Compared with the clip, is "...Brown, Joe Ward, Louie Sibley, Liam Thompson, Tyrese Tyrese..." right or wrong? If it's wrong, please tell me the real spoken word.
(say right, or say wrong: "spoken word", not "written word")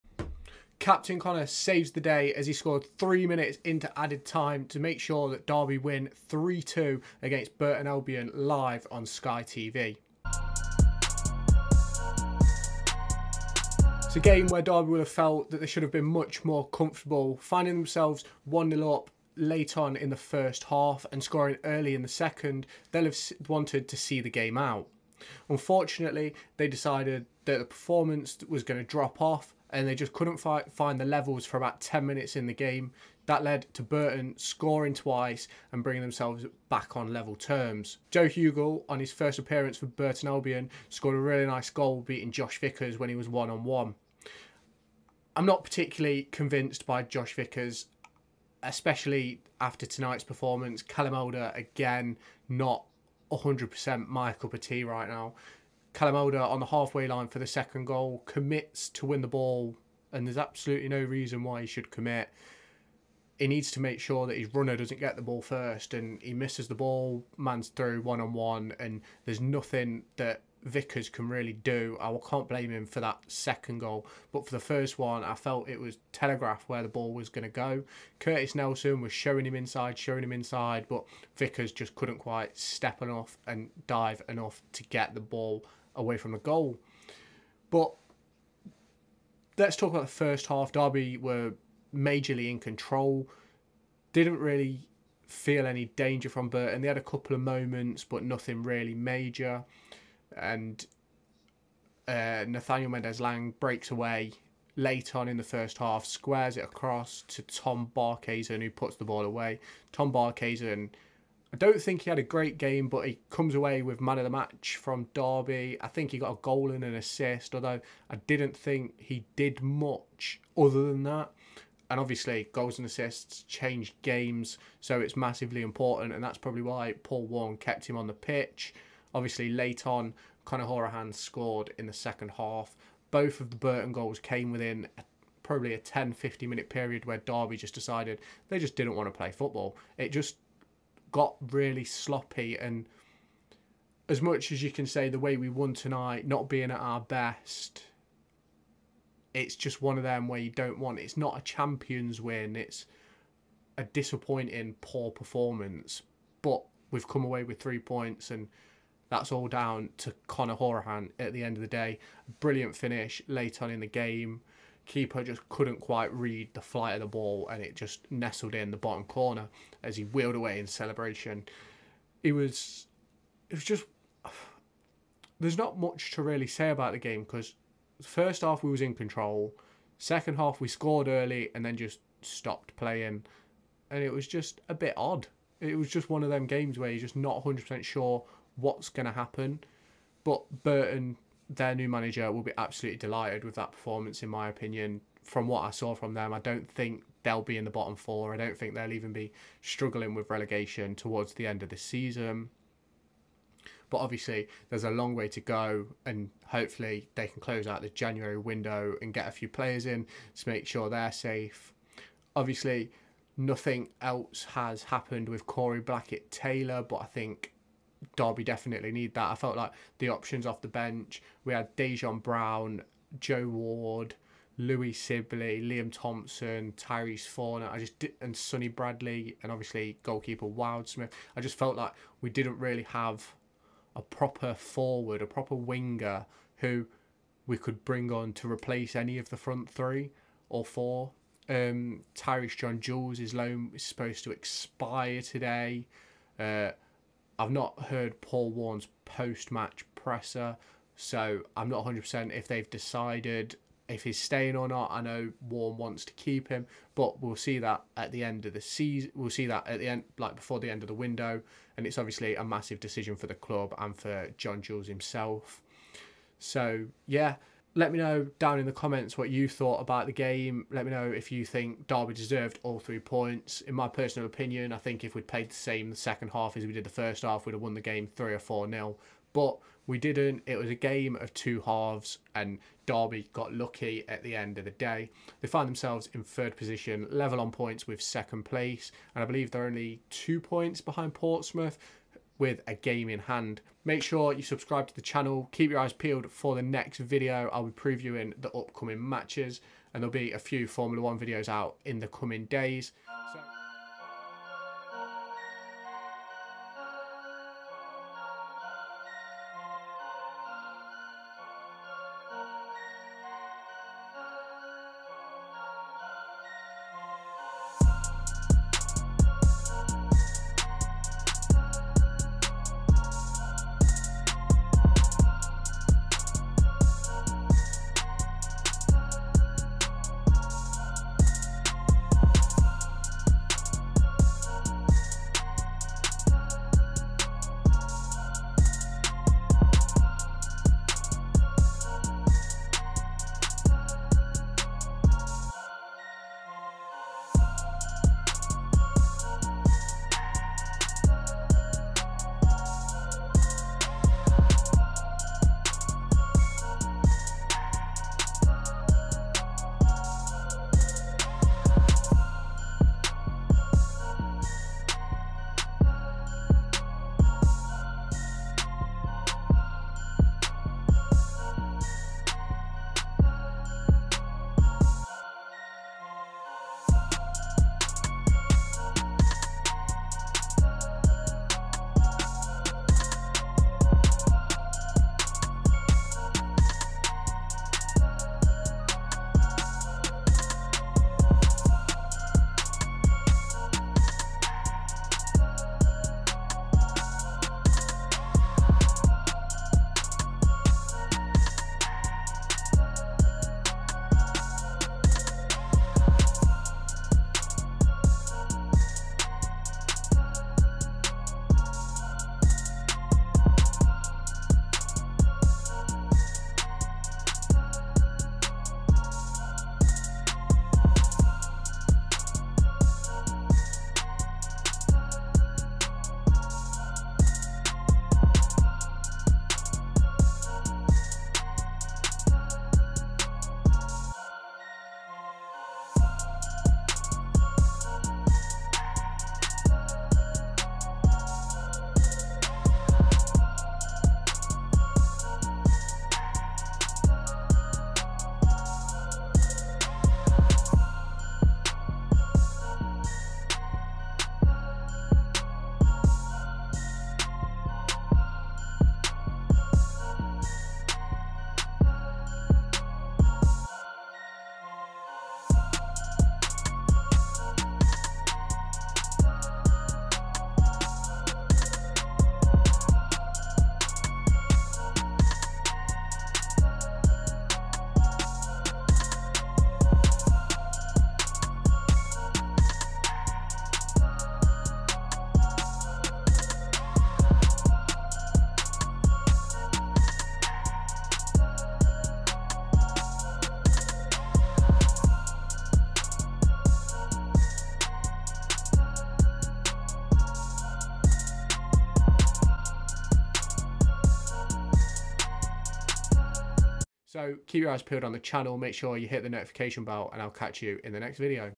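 wrong: "Fornah", not "Tyrese".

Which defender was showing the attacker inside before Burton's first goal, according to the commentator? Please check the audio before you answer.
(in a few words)
Curtis Nelson.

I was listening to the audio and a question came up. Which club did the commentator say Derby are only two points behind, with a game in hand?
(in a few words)
Portsmouth.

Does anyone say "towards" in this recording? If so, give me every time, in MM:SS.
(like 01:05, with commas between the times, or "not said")
03:20.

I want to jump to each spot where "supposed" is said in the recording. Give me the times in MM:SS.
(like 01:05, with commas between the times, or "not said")
04:03.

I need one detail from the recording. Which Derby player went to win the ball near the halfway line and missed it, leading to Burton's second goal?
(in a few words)
Kalamoda.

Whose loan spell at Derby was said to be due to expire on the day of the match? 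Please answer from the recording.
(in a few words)
Tyreece John-Jules.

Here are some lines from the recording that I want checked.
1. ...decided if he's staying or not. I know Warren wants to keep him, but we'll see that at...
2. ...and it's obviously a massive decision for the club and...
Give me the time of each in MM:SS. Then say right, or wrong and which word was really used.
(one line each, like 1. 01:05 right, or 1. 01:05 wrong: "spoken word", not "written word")
1. 04:12 right
2. 04:21 right.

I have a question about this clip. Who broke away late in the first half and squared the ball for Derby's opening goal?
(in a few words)
Nathaniel Mendez-Laing.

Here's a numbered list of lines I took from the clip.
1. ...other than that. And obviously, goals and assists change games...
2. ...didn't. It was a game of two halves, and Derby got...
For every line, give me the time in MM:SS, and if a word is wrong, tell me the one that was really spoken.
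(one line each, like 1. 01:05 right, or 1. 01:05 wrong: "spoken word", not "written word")
1. 02:00 right
2. 04:39 right.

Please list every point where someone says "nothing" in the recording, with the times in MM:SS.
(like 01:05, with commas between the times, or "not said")
01:09, 01:38, 03:33.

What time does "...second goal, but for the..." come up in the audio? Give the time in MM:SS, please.
01:13.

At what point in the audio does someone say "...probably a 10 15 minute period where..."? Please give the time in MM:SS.
02:15.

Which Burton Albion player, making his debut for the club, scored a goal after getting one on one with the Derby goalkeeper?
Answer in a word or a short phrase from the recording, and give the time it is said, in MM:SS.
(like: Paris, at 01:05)
Joe Hugill, at 00:38.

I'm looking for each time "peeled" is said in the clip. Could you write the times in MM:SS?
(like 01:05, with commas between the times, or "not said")
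04:55, 08:27.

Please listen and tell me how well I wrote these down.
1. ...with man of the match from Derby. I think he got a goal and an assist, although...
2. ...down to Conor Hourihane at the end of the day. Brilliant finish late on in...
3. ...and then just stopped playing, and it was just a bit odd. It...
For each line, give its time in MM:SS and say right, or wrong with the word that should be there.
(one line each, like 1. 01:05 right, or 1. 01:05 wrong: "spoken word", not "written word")
1. 01:53 right
2. 02:39 right
3. 03:01 right.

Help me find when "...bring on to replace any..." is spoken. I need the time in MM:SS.
03:57.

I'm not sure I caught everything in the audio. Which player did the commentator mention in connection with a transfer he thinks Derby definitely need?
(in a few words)
Corey Blackett Taylor.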